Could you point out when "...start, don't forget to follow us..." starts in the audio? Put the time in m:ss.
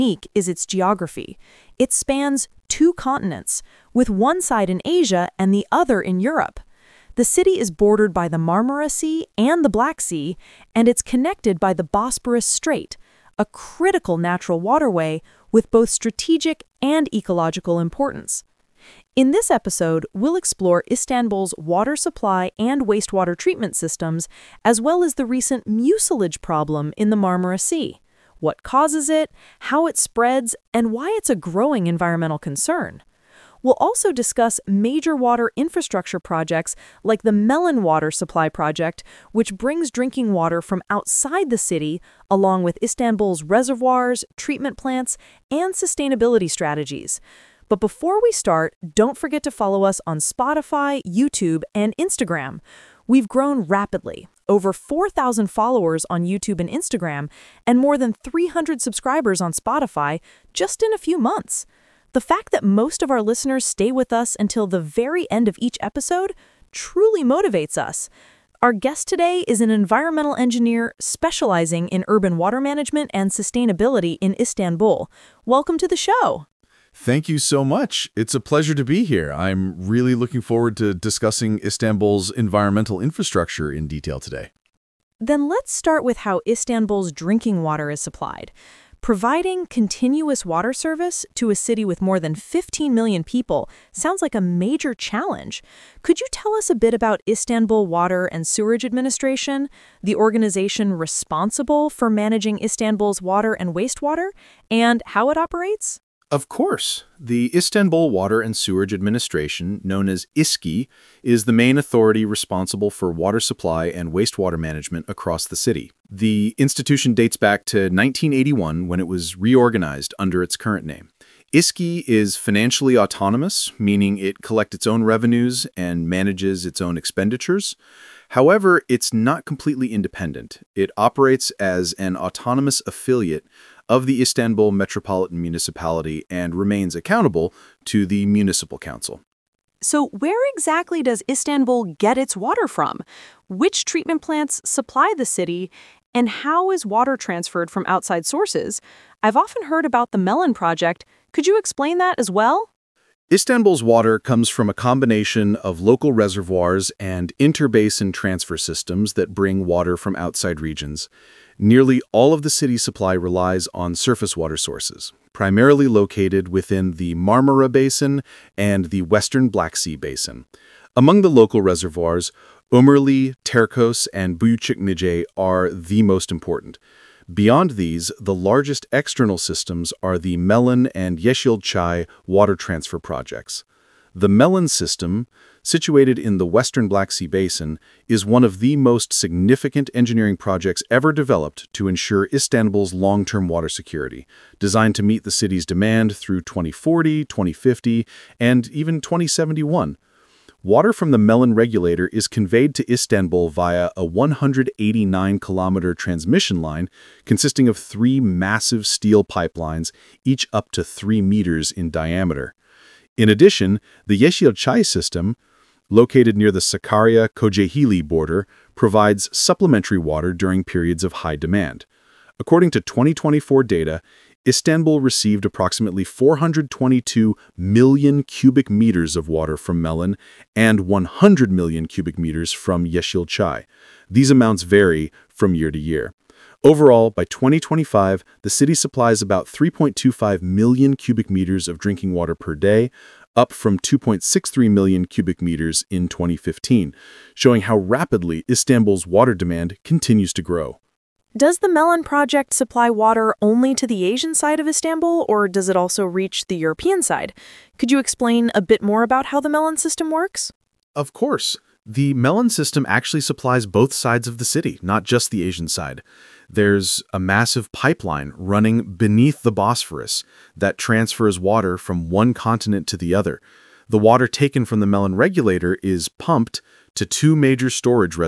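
0:48.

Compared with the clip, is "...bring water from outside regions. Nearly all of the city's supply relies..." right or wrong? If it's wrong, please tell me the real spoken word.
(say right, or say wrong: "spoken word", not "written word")
right.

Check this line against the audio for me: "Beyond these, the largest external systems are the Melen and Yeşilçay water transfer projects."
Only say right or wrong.
right.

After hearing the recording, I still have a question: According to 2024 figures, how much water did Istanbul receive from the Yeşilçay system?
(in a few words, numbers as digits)
100 million cubic meters.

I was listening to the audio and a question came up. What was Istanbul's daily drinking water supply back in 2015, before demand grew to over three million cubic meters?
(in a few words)
2.63 million cubic meters.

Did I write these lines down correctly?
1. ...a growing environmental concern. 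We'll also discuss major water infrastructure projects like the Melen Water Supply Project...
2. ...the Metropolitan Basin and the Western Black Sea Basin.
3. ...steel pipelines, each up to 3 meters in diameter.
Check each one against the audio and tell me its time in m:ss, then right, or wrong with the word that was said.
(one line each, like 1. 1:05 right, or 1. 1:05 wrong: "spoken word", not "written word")
1. 0:31 right
2. 2:46 wrong: "Marmara", not "Metropolitan"
3. 3:28 right.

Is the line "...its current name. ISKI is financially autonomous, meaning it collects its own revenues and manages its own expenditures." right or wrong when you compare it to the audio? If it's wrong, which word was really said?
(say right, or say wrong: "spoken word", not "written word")
right.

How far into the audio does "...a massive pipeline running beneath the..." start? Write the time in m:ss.
4:27.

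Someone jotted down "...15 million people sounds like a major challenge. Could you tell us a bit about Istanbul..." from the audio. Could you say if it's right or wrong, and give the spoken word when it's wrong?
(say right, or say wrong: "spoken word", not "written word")
right.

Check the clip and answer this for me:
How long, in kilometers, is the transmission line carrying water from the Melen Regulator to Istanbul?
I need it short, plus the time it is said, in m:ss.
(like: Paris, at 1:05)
189 kilometers, at 3:24.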